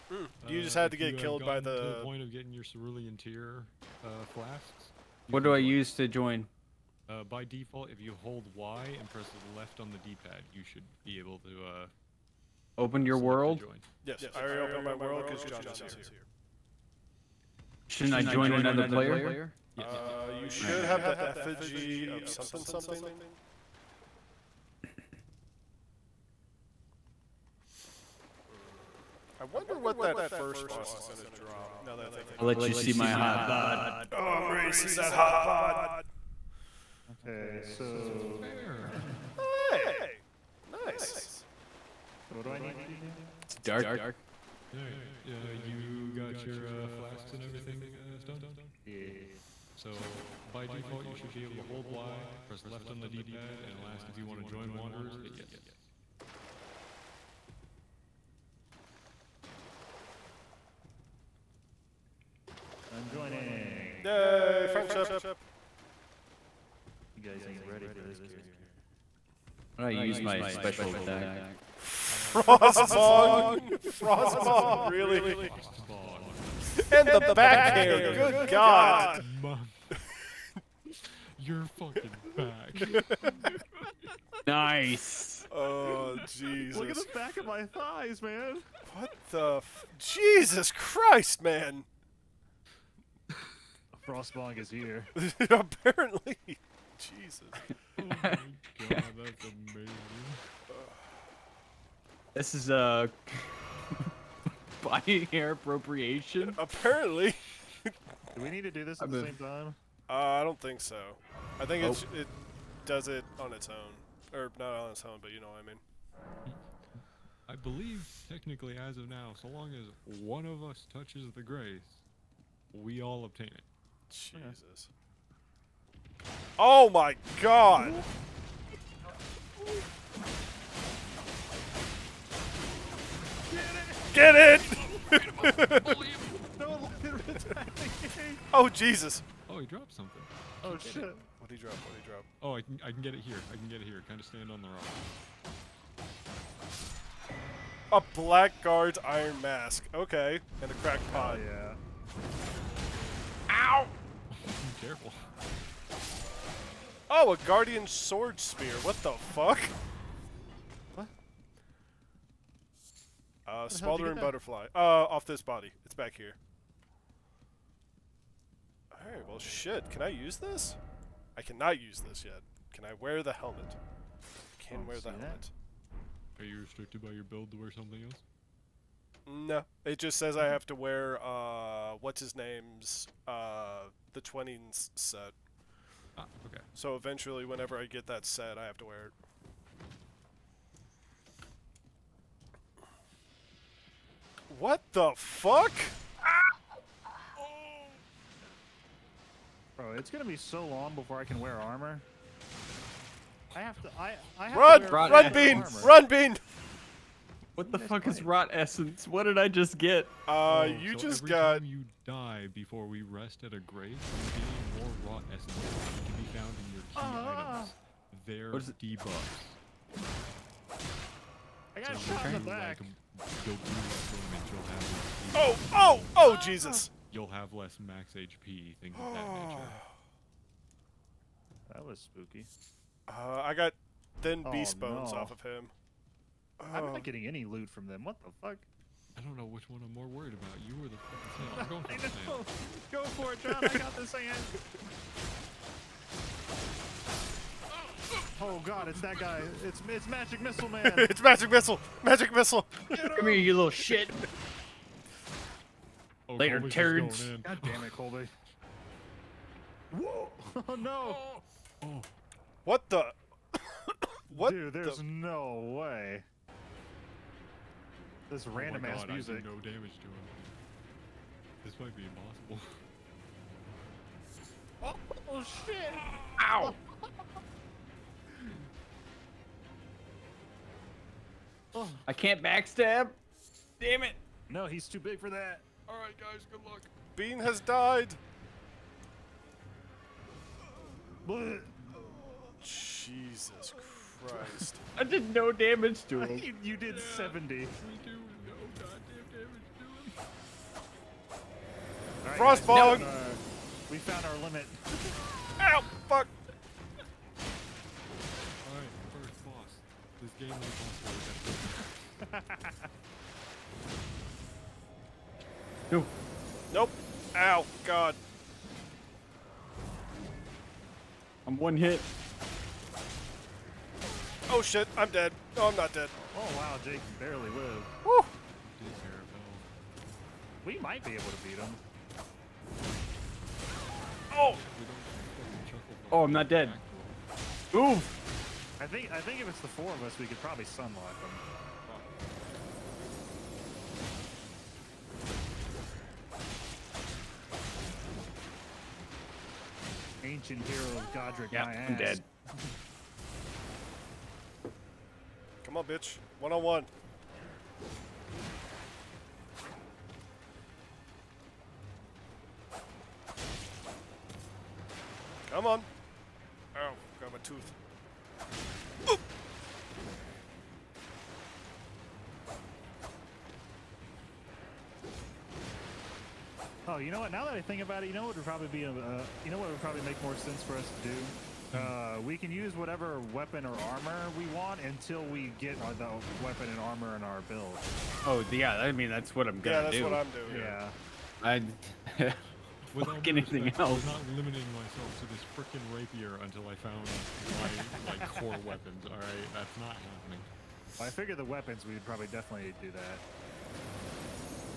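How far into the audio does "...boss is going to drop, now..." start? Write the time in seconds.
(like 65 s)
30 s.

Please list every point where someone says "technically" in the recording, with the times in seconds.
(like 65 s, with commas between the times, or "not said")
118 s.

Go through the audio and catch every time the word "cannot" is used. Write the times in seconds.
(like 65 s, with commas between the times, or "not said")
171 s.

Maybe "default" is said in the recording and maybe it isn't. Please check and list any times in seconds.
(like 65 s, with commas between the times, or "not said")
7 s, 50 s.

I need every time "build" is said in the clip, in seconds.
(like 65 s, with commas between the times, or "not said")
177 s, 387 s.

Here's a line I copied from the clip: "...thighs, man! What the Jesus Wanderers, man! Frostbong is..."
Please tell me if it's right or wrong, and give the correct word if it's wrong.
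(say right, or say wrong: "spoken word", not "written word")
wrong: "Christ", not "Wanderers".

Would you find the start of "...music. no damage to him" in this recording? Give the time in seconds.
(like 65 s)
269 s.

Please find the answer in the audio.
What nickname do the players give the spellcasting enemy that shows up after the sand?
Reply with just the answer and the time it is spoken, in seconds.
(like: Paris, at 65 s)
Magic Missile Man, at 250 s.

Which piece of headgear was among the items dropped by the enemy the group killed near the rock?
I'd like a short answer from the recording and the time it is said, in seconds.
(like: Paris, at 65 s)
Blackguard's iron mask, at 148 s.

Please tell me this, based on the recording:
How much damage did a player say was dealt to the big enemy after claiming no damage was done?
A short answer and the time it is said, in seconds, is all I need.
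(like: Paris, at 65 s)
70, at 297 s.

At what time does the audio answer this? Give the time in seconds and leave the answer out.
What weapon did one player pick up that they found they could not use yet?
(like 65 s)
157 s.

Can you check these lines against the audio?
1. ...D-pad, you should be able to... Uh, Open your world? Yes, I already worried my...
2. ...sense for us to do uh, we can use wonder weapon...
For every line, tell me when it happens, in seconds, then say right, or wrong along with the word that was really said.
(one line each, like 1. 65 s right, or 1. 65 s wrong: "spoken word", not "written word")
1. 9 s wrong: "opened", not "worried"
2. 380 s wrong: "whatever", not "wonder".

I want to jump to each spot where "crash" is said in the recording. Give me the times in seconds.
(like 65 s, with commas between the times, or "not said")
not said.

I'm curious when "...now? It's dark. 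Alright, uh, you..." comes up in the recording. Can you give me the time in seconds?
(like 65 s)
42 s.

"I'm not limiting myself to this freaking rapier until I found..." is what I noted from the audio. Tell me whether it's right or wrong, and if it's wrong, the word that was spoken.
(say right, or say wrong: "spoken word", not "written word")
right.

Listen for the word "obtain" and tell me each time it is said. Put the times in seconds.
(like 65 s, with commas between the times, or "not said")
123 s.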